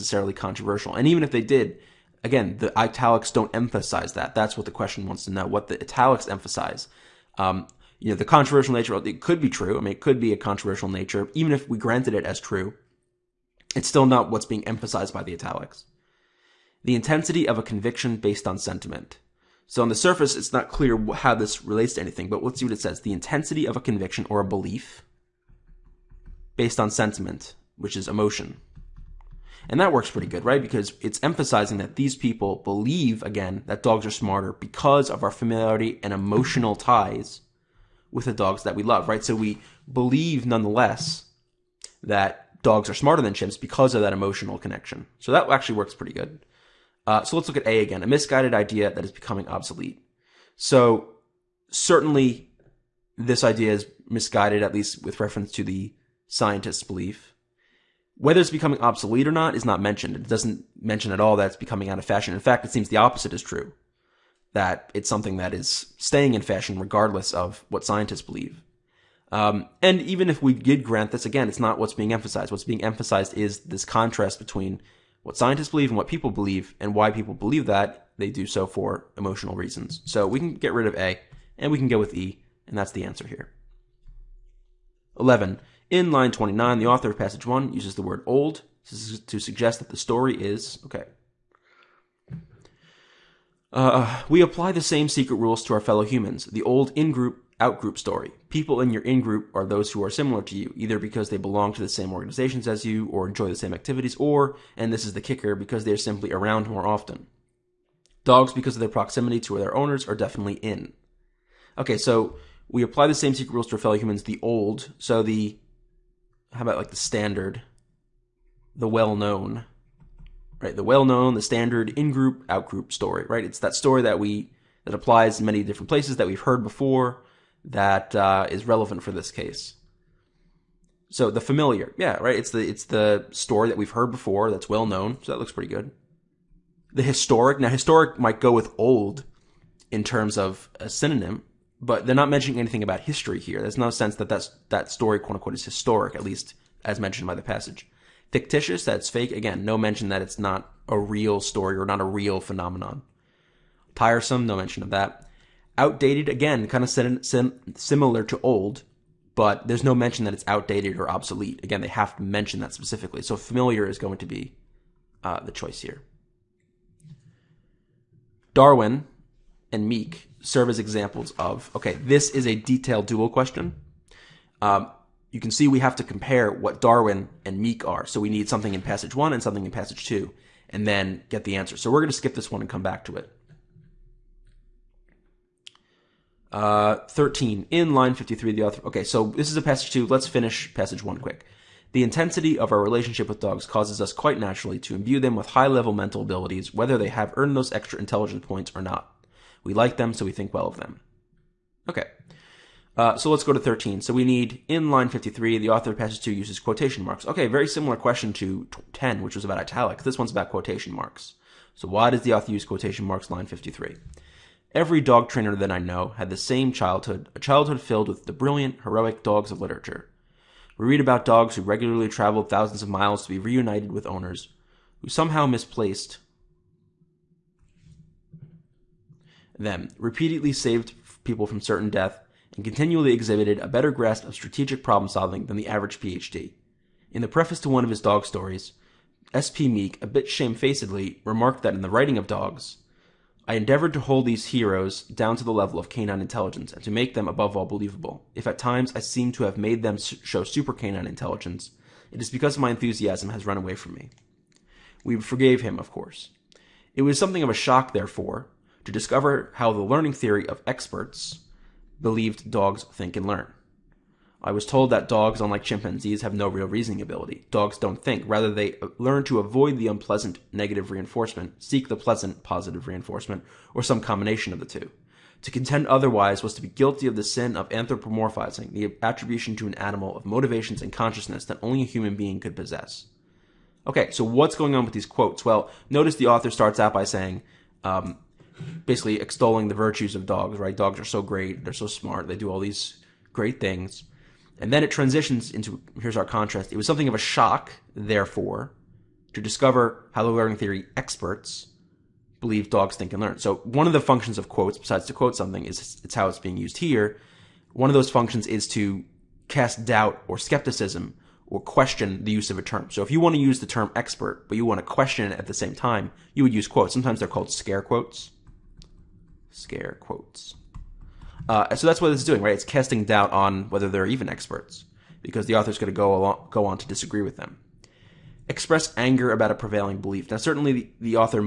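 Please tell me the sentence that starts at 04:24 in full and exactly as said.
I was told that dogs, unlike chimpanzees, have no real reasoning ability.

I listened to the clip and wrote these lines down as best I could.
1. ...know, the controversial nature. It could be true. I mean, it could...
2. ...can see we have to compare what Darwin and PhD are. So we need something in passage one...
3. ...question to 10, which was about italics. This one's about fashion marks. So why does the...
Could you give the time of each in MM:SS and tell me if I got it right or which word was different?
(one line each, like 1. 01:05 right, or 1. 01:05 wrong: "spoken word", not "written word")
1. 00:08 right
2. 02:55 wrong: "Meek", not "PhD"
3. 03:27 wrong: "quotation", not "fashion".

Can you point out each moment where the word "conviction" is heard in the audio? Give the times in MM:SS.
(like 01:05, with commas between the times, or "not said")
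00:17, 00:23.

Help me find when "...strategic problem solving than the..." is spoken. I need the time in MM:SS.
03:54.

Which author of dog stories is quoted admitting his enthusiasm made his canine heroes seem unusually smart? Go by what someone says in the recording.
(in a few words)
S.P. Meek.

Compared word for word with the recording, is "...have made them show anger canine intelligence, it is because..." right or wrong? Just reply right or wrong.
wrong.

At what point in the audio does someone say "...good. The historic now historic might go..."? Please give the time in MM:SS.
02:15.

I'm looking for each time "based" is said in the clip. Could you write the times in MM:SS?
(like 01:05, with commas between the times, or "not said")
00:18, 00:26.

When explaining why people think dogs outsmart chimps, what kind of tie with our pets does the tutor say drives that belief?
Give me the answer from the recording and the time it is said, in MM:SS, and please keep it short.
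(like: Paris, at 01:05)
emotional connection, at 00:44.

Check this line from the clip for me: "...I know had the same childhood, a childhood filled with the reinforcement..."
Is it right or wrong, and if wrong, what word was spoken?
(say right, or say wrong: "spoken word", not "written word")
wrong: "brilliant", not "reinforcement".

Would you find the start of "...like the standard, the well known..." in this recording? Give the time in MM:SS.
01:56.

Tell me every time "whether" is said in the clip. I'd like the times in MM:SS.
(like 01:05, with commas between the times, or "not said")
00:58, 03:16, 05:23.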